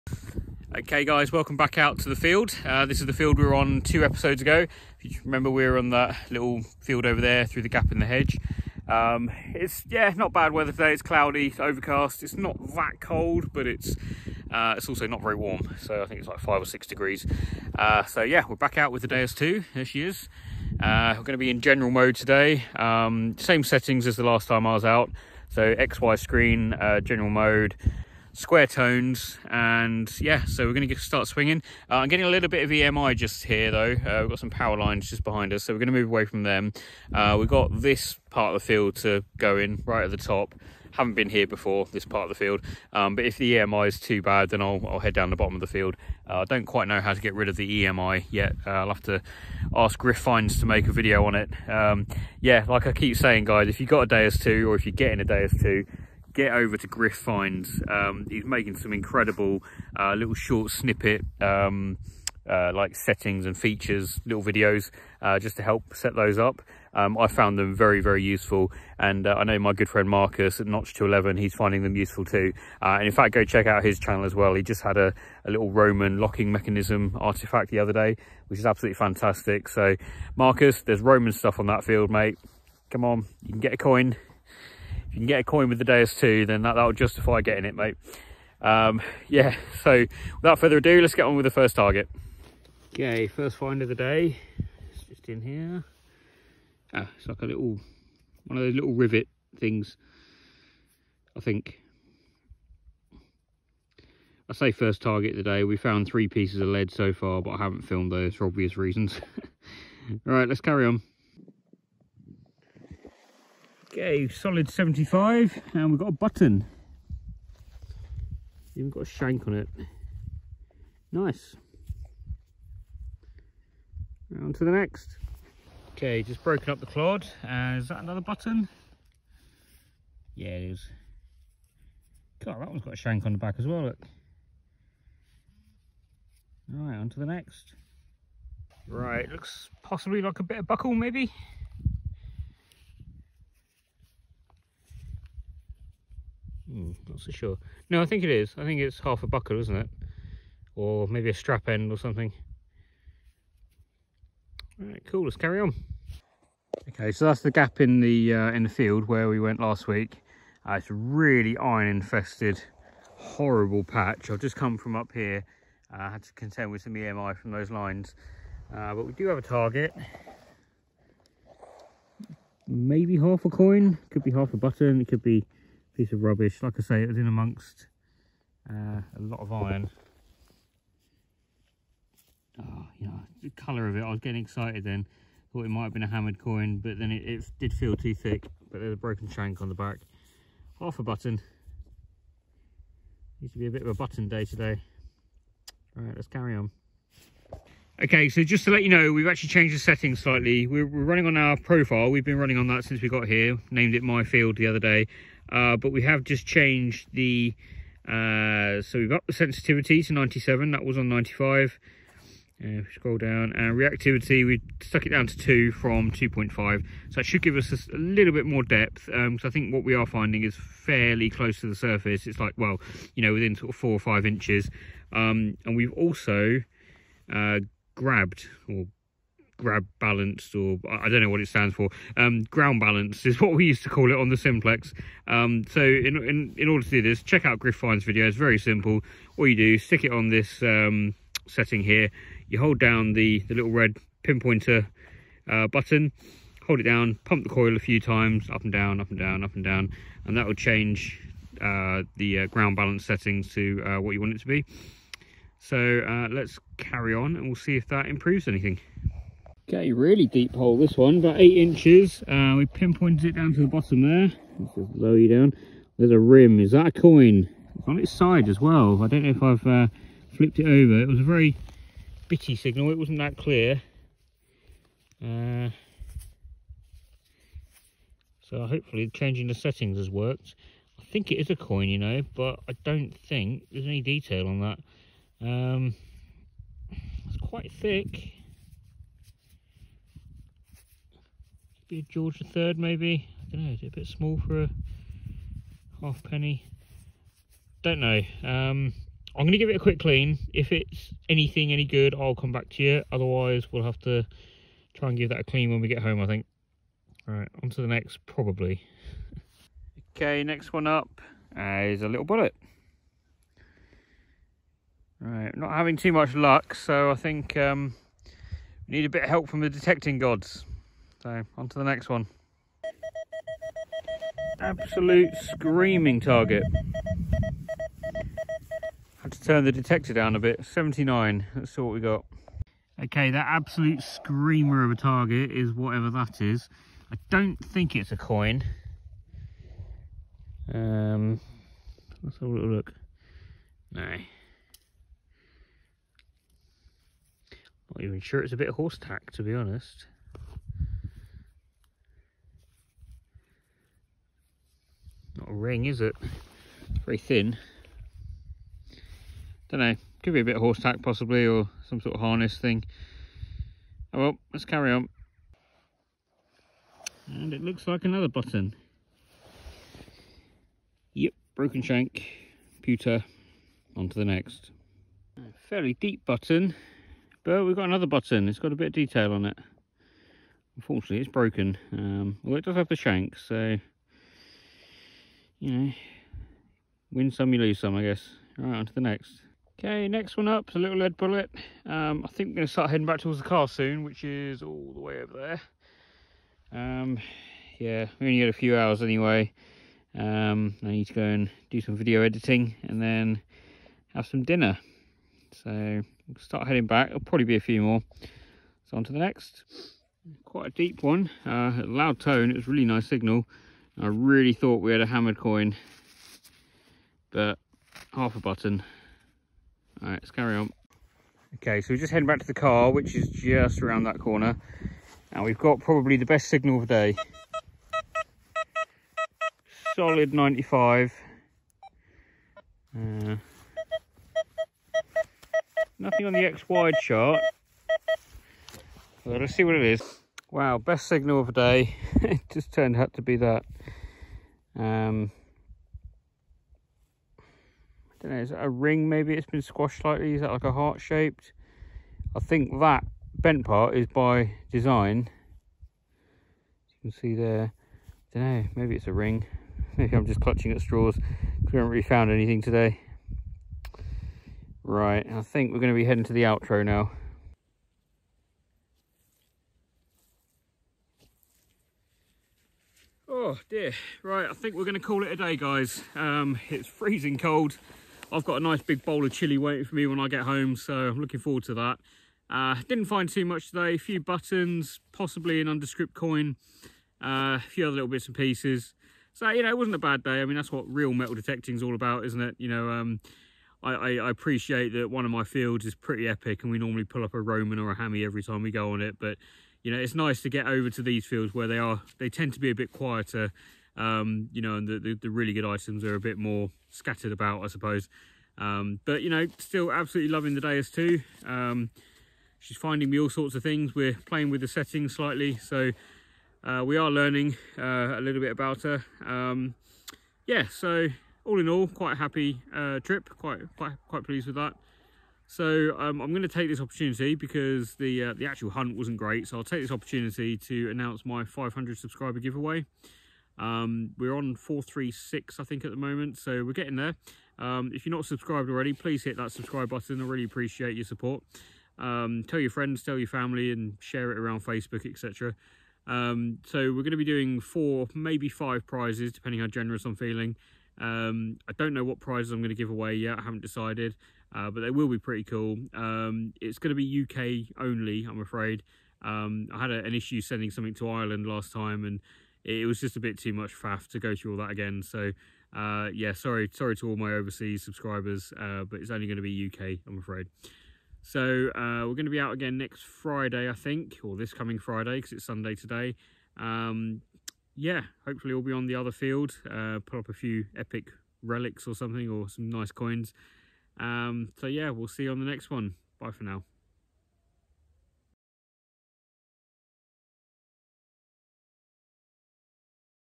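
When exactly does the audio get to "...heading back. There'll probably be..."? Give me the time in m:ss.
6:46.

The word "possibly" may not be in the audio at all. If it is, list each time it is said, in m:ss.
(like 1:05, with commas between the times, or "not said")
2:19, 6:01, 8:05.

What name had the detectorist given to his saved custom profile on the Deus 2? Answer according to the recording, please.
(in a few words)
My Field.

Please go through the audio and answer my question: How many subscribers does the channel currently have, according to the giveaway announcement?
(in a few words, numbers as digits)
436.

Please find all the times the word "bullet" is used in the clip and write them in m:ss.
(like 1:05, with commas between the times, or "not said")
5:12, 6:31.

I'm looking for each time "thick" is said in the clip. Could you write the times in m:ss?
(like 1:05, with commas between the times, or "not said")
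3:08, 4:47.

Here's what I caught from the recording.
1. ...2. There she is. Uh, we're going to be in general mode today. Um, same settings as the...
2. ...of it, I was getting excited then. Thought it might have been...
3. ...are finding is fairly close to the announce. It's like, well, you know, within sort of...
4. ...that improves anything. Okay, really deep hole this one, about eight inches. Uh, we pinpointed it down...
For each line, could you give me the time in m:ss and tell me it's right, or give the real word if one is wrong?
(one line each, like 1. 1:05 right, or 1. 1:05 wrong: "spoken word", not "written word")
1. 0:19 right
2. 3:03 right
3. 3:39 wrong: "surface", not "announce"
4. 4:17 right.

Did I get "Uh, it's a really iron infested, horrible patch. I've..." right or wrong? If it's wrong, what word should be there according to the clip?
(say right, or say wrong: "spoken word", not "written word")
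right.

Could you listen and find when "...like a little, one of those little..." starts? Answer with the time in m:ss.
1:37.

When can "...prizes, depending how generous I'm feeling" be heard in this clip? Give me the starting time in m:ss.
9:08.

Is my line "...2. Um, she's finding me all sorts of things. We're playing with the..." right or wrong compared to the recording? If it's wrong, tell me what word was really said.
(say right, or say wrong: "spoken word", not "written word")
right.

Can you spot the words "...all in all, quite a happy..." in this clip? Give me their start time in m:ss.
8:41.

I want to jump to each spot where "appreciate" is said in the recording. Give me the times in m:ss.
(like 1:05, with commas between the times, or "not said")
8:14, 9:00.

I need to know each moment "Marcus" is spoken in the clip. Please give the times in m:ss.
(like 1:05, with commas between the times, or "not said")
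1:10, 1:20.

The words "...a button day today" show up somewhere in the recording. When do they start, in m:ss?
3:13.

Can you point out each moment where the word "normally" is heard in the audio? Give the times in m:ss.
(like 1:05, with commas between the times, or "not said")
8:16.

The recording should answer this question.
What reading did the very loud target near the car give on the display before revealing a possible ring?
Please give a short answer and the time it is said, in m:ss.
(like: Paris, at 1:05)
95, at 7:09.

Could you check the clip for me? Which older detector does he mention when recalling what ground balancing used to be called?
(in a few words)
Simplex.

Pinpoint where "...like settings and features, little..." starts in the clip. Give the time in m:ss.
1:02.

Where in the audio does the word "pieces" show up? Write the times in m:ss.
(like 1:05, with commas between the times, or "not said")
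1:46, 2:55, 8:08.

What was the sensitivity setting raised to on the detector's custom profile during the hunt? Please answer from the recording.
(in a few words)
97.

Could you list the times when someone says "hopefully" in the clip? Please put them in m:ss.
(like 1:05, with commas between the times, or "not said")
4:38, 9:38.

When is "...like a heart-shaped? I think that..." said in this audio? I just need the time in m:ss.
7:30.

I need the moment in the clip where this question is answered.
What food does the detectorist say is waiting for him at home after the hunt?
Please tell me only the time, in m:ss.
7:59.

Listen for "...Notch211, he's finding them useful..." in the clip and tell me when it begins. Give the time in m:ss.
1:10.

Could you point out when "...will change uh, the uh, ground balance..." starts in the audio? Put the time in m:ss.
4:10.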